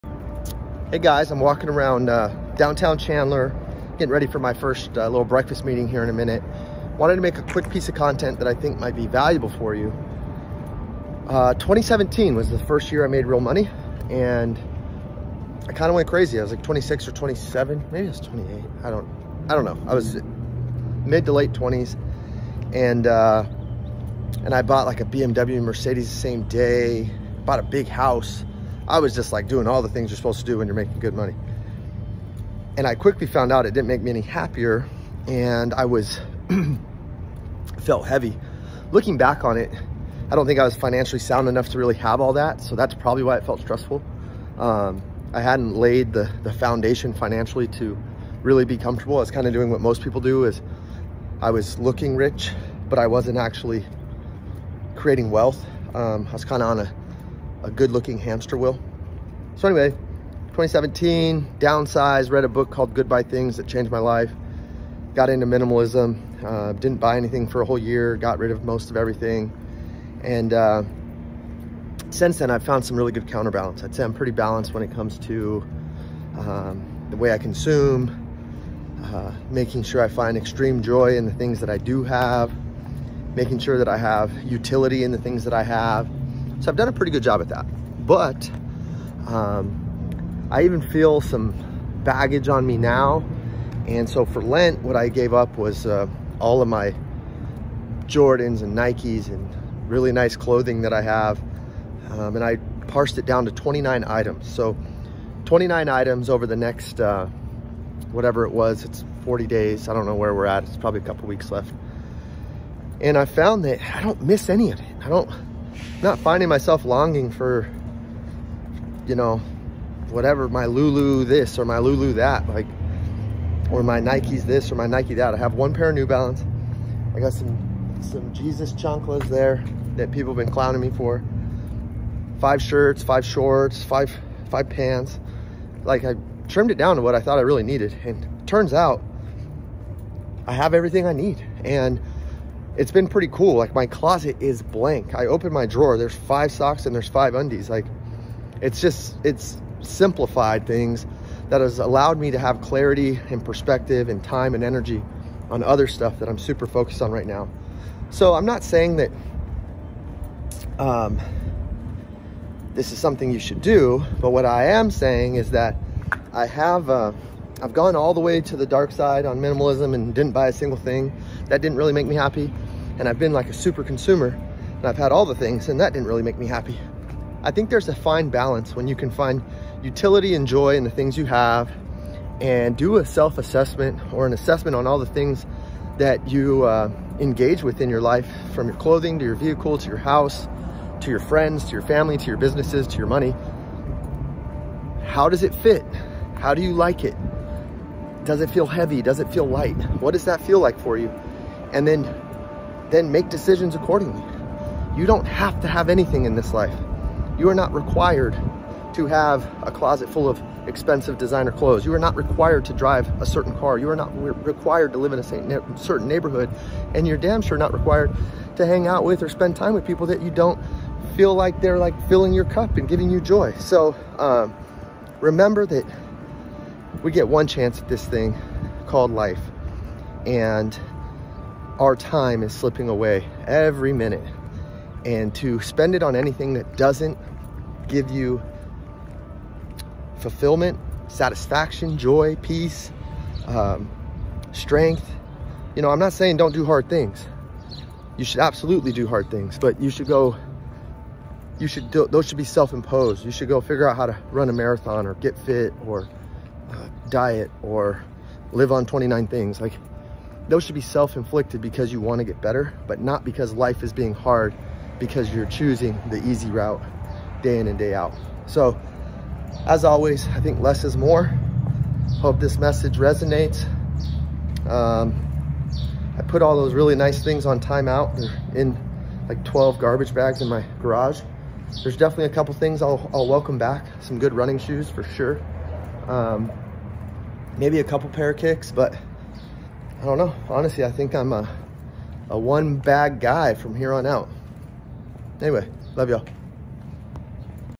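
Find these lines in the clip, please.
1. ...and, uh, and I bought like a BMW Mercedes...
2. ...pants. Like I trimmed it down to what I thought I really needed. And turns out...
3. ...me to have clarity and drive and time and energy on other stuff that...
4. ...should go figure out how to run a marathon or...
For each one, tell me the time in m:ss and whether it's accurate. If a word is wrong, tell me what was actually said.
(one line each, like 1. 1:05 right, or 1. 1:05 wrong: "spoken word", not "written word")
1. 0:22 right
2. 2:14 right
3. 2:32 wrong: "perspective", not "drive"
4. 4:13 right.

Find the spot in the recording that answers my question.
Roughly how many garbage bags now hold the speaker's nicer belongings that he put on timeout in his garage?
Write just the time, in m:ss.
4:39.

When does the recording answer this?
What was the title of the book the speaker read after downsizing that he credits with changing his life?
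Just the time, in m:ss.
1:02.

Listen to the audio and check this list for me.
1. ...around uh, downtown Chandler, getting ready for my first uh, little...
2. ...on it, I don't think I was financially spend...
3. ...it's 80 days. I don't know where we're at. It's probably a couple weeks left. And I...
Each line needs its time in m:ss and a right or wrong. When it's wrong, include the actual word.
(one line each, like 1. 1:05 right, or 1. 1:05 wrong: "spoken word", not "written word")
1. 0:01 right
2. 0:39 wrong: "sound", not "spend"
3. 1:48 wrong: "40", not "80".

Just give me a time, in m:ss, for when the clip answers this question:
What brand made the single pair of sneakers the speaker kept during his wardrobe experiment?
2:05.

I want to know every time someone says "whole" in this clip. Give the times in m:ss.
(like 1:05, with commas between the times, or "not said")
1:07.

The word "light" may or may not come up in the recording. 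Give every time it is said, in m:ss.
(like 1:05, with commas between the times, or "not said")
3:19.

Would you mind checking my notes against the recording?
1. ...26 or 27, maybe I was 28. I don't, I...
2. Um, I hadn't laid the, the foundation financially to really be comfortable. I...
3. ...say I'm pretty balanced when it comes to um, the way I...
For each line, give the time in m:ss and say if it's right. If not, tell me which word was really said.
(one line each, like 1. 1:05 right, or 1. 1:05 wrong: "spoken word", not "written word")
1. 0:16 right
2. 0:44 right
3. 1:13 right.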